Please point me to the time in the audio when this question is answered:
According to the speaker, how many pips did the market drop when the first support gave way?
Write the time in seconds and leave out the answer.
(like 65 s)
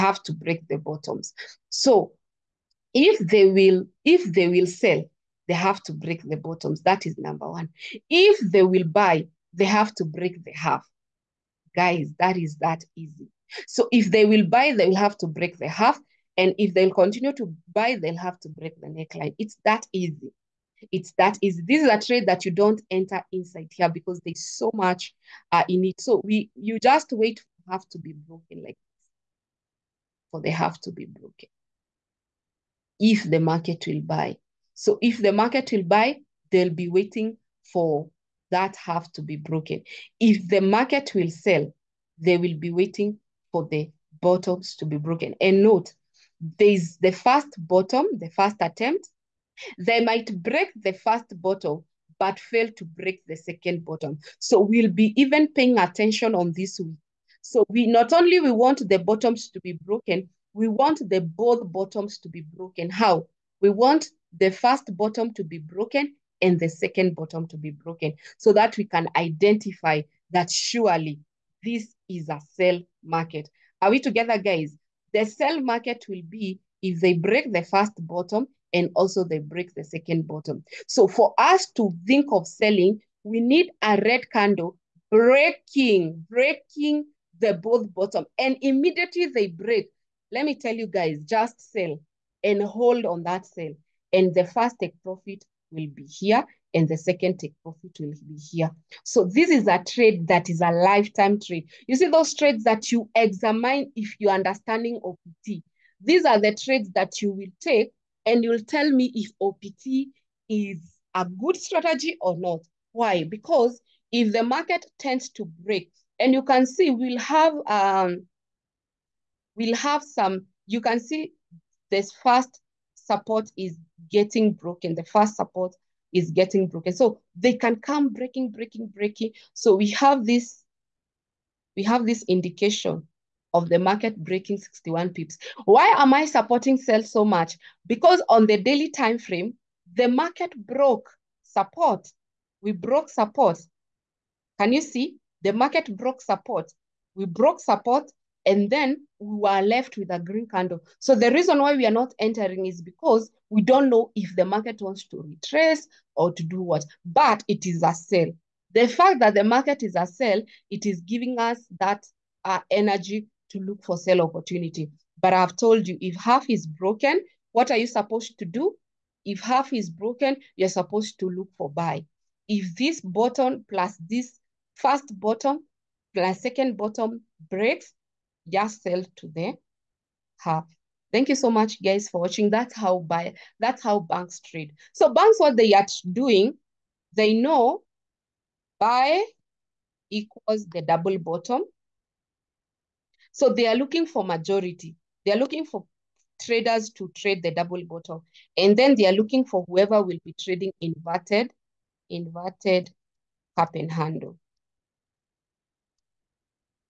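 134 s.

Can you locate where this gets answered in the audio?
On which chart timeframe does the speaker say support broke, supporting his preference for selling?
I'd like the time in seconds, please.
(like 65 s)
138 s.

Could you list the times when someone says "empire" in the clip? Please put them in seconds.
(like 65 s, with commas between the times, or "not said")
not said.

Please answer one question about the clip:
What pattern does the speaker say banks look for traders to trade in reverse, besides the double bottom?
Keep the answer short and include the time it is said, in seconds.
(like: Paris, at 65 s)
Inverted cup and handle, at 202 s.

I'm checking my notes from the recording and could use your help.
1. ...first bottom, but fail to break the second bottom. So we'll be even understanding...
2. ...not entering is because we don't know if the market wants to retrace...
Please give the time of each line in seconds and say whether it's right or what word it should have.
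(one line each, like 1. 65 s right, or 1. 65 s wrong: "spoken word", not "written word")
1. 50 s wrong: "paying", not "understanding"
2. 151 s right.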